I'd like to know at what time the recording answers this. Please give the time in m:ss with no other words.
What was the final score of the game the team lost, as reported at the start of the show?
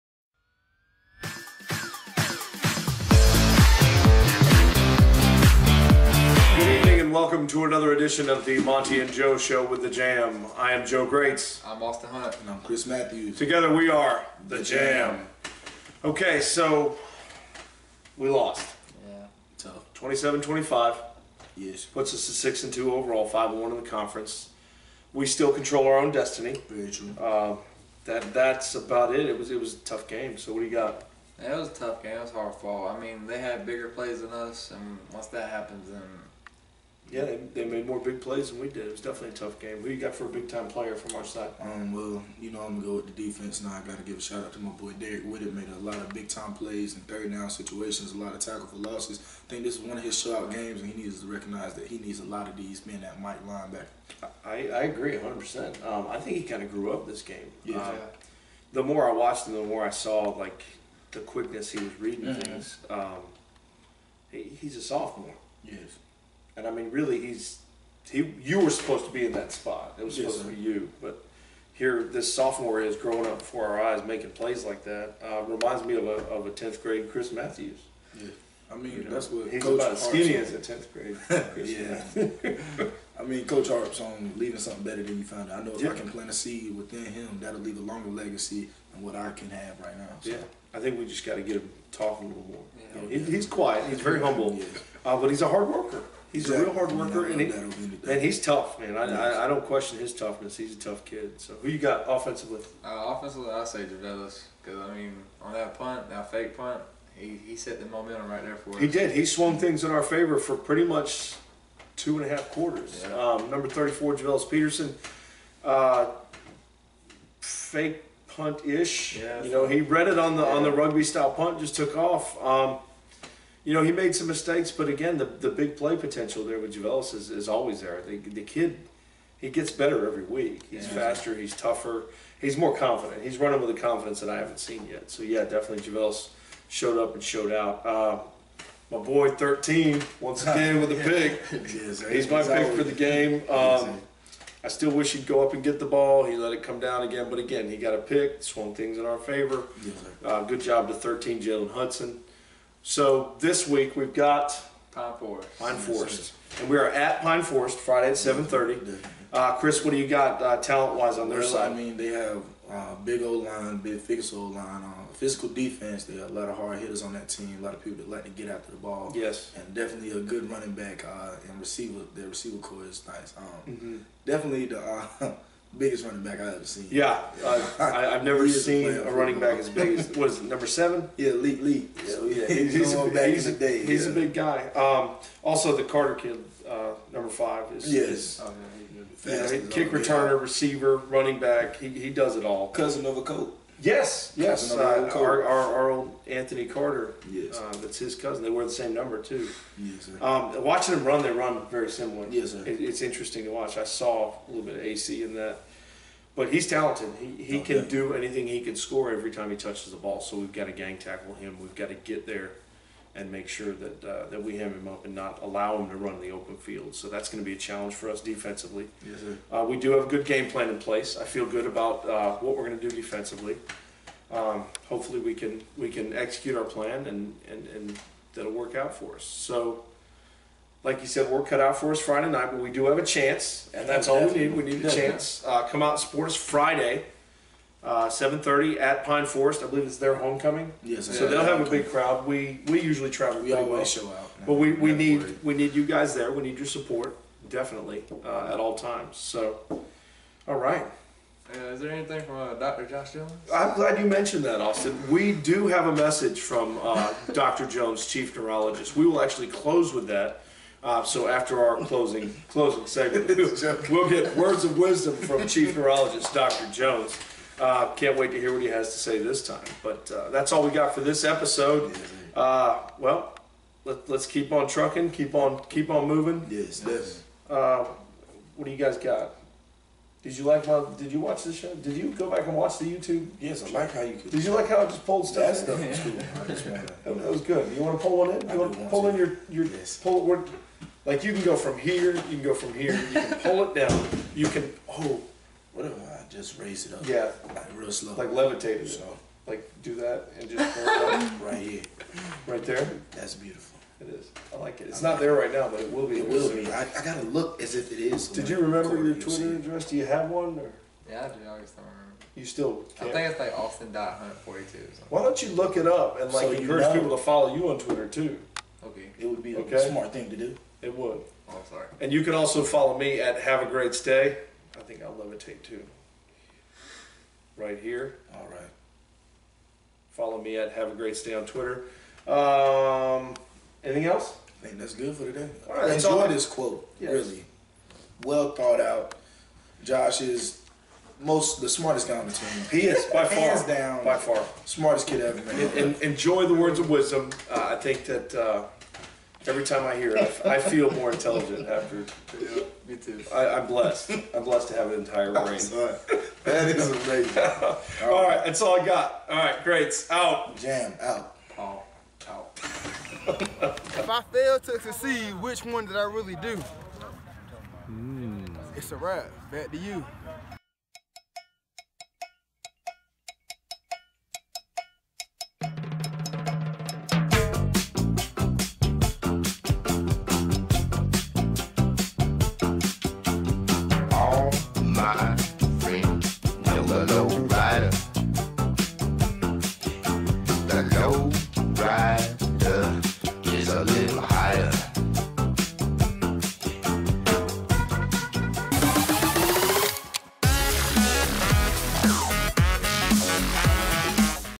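0:19.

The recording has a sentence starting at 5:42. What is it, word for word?
He is by far, hands down, by far, smartest kid ever.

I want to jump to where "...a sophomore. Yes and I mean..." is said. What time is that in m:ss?
1:04.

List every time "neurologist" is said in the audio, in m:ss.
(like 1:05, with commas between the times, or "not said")
4:18, 4:25.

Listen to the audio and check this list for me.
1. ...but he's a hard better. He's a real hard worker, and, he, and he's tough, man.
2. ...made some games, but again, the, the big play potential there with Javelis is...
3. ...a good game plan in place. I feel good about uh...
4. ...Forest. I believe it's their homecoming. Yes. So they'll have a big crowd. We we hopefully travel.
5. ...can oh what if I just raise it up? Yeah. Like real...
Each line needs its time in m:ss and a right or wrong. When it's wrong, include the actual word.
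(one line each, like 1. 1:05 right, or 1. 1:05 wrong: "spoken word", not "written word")
1. 1:35 wrong: "worker", not "better"
2. 2:03 wrong: "mistakes", not "games"
3. 3:40 right
4. 3:59 wrong: "usually", not "hopefully"
5. 4:54 right.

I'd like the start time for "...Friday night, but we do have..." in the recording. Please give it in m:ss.
3:51.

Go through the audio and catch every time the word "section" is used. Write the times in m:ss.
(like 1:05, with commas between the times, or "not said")
not said.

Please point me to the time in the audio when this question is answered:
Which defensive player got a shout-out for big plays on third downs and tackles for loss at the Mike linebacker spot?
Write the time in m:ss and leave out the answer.
0:44.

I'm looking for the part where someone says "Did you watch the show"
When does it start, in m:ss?
4:40.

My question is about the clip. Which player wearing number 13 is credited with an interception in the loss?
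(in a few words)
Jalen Hudson.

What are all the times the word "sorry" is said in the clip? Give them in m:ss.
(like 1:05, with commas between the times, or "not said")
5:21.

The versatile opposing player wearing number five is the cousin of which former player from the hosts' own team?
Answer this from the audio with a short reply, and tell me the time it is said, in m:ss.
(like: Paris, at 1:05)
Anthony Carter, at 3:16.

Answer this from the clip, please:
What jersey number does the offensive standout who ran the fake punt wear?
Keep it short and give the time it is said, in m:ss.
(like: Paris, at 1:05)
34, at 1:53.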